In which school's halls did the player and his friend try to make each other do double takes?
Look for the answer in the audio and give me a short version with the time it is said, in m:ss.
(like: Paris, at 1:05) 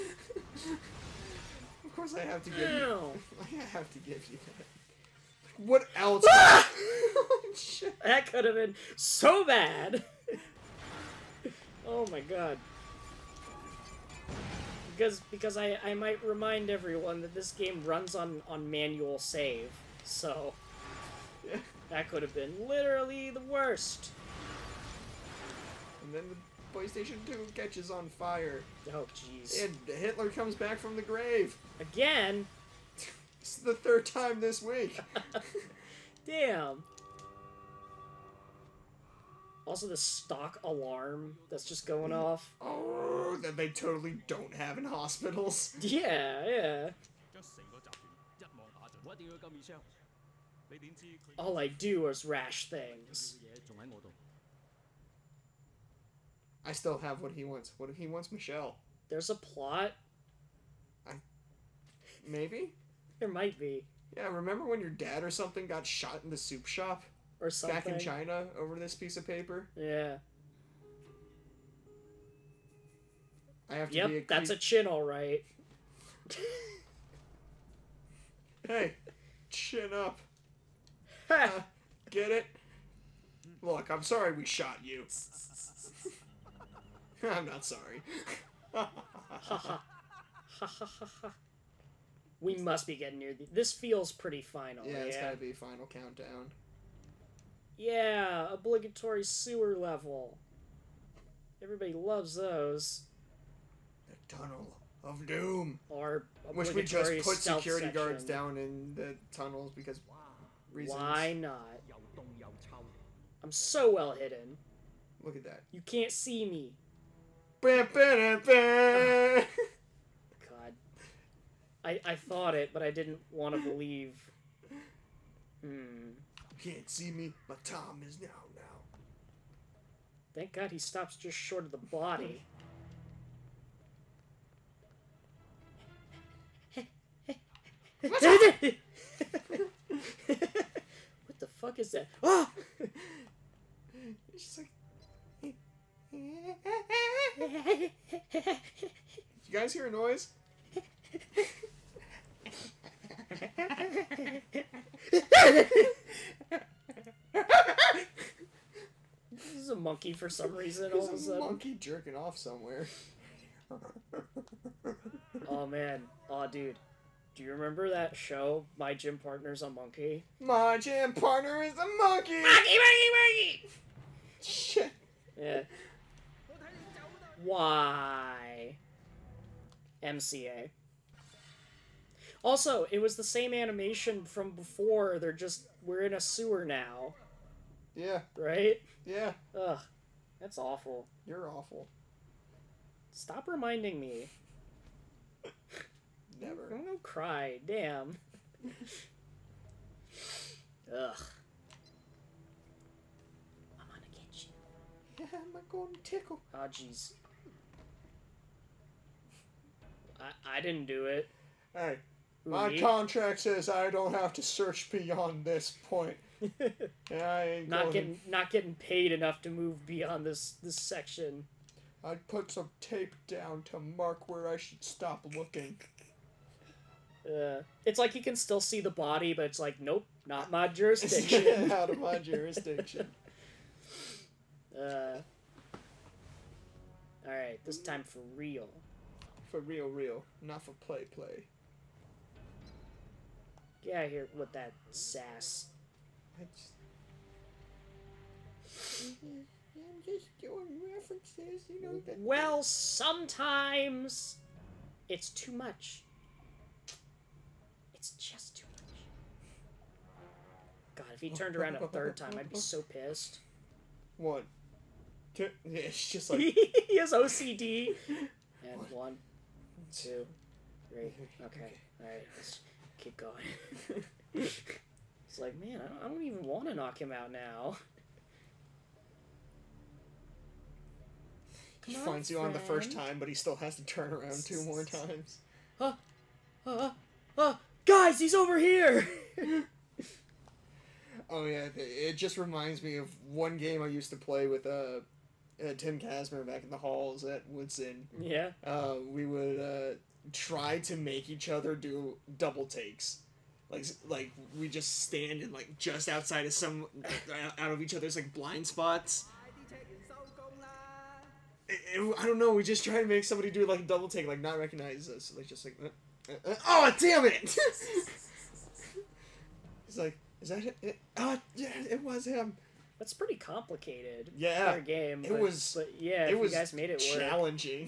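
Woodson, at 4:57.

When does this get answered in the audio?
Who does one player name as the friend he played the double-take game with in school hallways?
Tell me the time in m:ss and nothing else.
4:55.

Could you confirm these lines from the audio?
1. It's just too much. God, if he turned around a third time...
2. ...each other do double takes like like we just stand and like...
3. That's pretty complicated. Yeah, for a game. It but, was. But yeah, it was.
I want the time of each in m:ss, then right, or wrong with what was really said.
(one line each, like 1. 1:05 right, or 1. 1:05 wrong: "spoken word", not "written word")
1. 4:17 right
2. 5:01 right
3. 5:22 right.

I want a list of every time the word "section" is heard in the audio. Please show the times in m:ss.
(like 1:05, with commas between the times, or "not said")
1:47, 3:40.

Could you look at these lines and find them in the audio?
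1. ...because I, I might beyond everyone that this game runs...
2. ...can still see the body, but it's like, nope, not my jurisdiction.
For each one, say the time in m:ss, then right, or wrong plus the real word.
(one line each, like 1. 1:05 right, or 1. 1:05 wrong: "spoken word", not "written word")
1. 0:15 wrong: "remind", not "beyond"
2. 3:48 right.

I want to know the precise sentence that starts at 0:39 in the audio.
Also, the stock alarm that's just going off.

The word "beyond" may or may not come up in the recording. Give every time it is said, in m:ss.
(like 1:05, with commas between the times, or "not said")
3:34, 3:39.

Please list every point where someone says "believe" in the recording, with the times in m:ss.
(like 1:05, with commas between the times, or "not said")
2:03.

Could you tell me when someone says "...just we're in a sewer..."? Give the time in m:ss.
3:05.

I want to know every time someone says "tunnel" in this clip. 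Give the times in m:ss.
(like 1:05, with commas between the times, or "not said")
1:44, 1:49.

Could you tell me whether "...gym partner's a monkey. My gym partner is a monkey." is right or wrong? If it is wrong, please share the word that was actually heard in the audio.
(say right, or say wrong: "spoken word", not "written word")
right.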